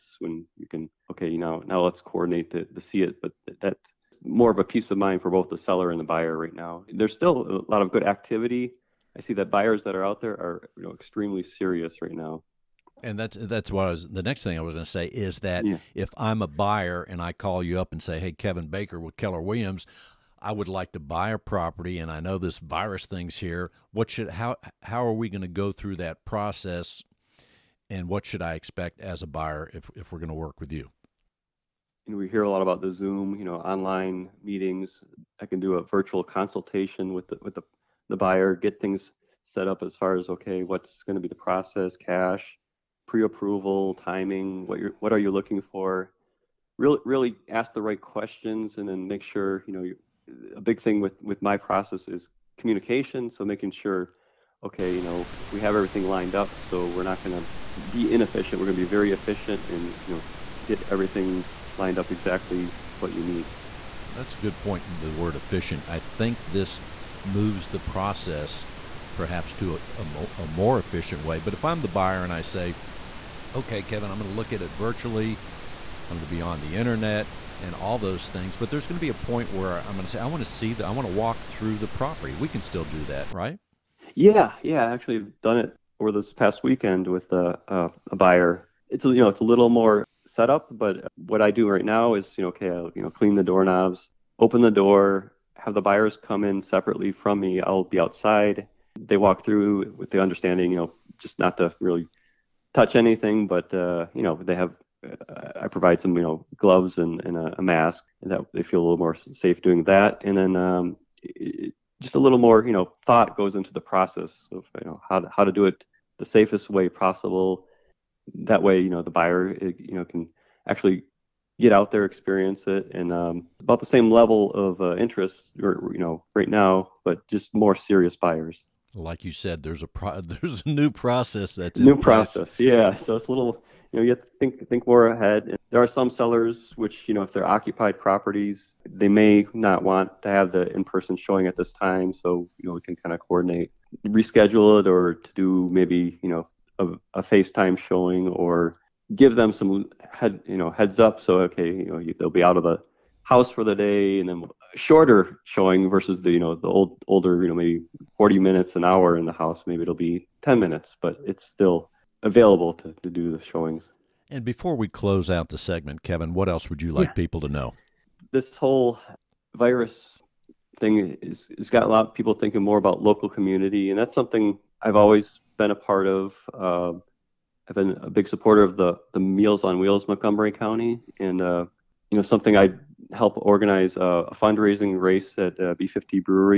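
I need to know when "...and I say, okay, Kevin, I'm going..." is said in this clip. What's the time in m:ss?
1:12.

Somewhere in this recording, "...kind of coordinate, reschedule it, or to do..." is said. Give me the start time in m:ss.
2:22.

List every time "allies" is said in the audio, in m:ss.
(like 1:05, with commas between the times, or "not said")
not said.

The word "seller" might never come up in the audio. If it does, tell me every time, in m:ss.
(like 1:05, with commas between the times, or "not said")
0:05, 2:16.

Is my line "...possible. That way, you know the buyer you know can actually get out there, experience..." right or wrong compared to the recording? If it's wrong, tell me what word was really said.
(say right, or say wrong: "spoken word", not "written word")
right.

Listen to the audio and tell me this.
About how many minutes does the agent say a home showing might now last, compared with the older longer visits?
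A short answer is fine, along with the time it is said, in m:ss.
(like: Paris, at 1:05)
10 minutes, at 2:40.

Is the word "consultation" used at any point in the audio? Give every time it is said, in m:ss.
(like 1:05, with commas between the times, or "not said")
0:36.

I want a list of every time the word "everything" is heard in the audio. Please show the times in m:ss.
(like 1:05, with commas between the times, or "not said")
0:55, 1:00.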